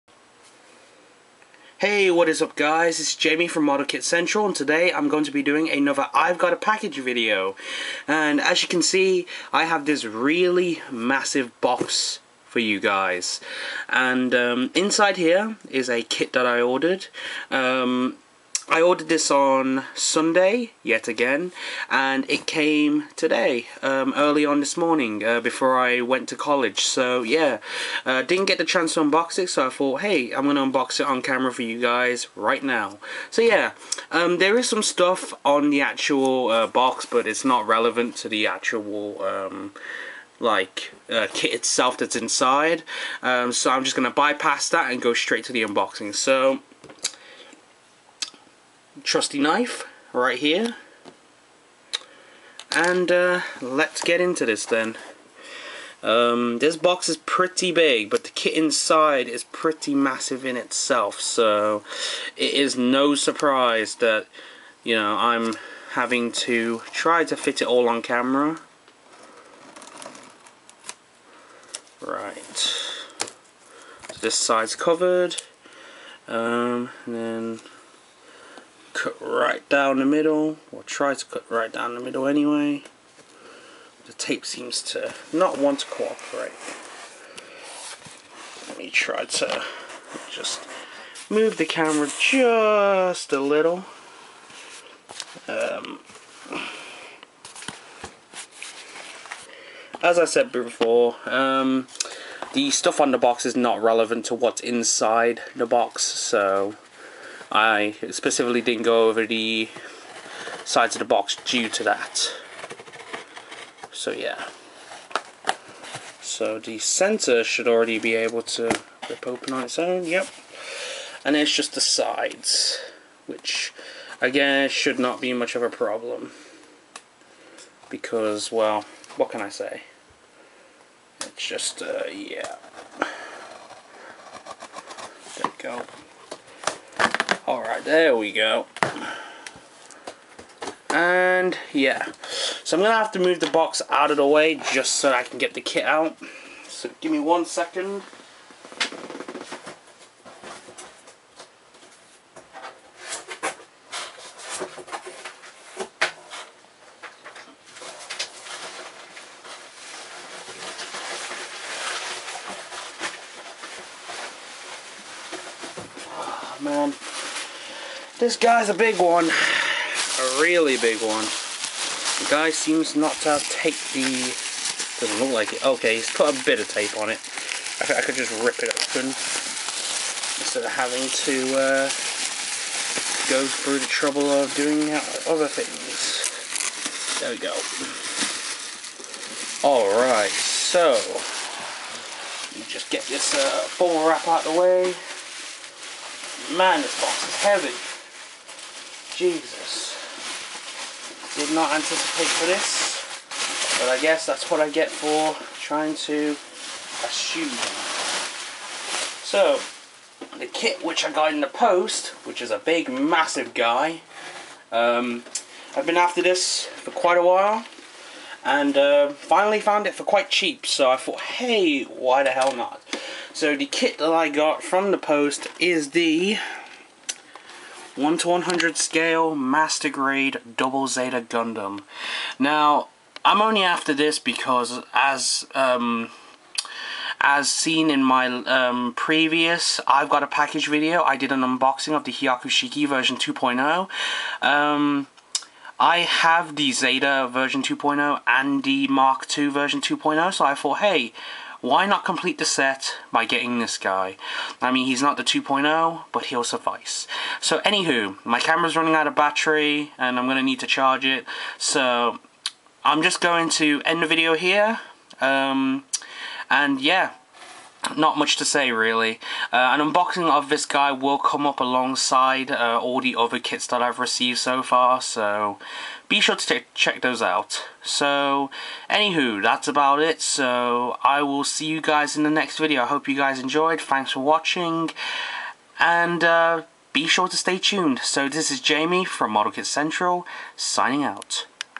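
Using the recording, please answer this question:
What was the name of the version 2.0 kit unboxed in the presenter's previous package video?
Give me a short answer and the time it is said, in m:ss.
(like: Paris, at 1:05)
Hyakushiki, at 4:02.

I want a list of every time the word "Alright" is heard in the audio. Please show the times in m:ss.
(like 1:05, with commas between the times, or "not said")
2:17, 3:09.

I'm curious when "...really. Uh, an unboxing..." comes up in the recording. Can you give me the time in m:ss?
4:28.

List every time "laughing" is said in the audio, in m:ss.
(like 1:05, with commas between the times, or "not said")
not said.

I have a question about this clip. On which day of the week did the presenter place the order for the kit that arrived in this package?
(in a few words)
Sunday.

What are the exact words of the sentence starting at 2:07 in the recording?
Because, well, what can I say?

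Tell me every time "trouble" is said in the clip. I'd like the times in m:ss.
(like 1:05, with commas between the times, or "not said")
3:03.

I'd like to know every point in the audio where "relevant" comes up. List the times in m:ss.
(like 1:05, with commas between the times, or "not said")
0:37, 1:43.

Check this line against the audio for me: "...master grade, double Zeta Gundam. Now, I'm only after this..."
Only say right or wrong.
right.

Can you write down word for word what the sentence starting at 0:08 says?
And as you can see, I have this really massive box for you guys.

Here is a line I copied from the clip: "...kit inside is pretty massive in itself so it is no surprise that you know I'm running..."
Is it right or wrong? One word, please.
wrong.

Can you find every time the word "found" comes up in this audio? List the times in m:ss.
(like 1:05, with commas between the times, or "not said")
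3:39.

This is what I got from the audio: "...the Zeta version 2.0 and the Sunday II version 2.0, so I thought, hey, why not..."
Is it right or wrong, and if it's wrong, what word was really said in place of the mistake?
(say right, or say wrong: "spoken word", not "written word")
wrong: "Mark", not "Sunday".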